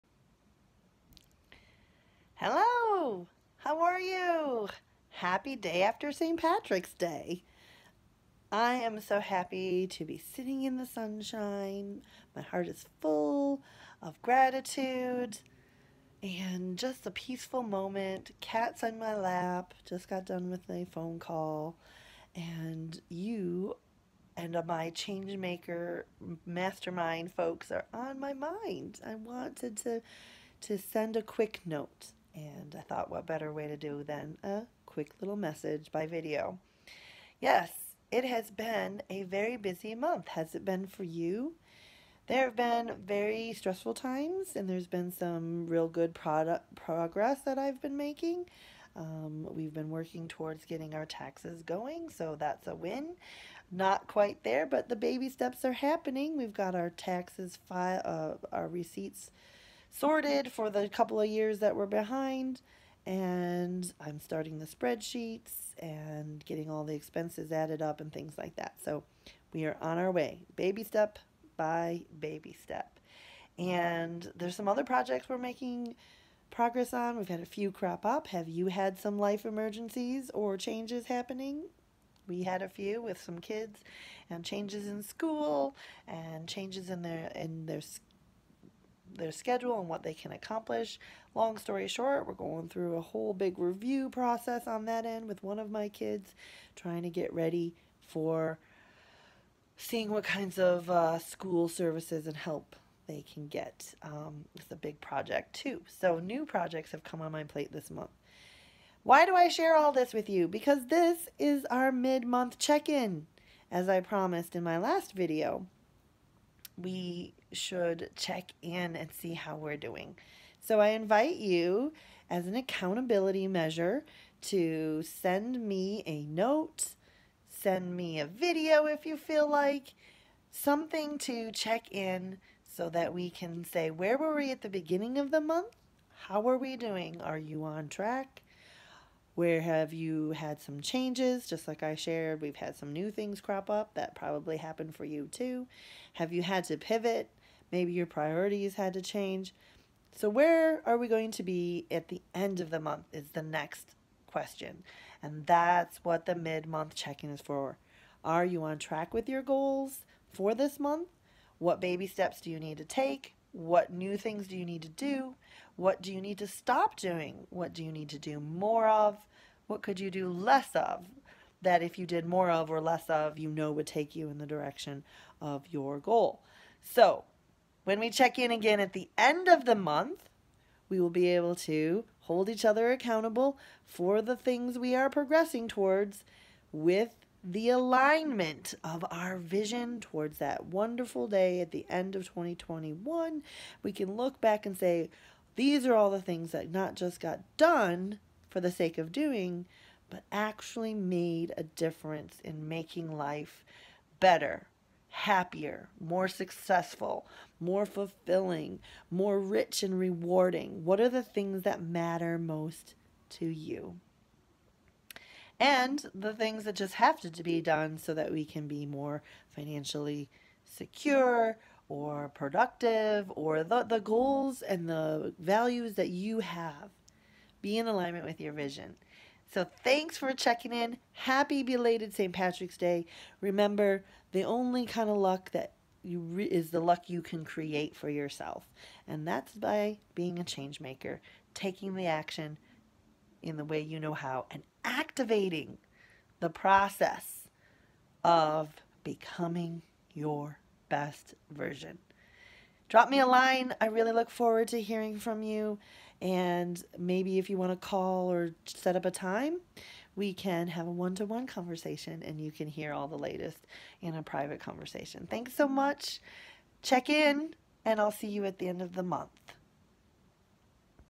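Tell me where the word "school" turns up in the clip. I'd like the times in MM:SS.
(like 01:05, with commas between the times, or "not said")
01:25, 01:41.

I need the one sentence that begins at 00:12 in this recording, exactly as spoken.
My heart is full of gratitude and just a peaceful moment.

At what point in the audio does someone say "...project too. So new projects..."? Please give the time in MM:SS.
01:44.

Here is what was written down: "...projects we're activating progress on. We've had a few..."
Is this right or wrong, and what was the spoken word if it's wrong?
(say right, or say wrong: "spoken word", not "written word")
wrong: "making", not "activating".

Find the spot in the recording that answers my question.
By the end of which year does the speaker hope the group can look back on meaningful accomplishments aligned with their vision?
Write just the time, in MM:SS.
03:12.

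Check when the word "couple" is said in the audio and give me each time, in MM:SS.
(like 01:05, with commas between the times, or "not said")
01:00.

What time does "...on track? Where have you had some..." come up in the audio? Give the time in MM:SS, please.
02:17.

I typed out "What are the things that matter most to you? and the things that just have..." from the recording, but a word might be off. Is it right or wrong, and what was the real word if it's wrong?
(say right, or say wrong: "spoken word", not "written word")
right.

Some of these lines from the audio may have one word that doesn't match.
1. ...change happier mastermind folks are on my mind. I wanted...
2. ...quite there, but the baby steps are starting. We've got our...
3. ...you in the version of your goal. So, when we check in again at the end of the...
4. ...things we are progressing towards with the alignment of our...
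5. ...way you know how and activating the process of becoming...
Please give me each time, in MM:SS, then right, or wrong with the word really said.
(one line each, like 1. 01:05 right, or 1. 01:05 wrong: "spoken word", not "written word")
1. 00:24 wrong: "maker", not "happier"
2. 00:54 wrong: "happening", not "starting"
3. 02:54 wrong: "direction", not "version"
4. 03:04 right
5. 04:03 right.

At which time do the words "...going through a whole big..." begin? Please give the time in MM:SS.
01:32.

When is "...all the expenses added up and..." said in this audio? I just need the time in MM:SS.
01:06.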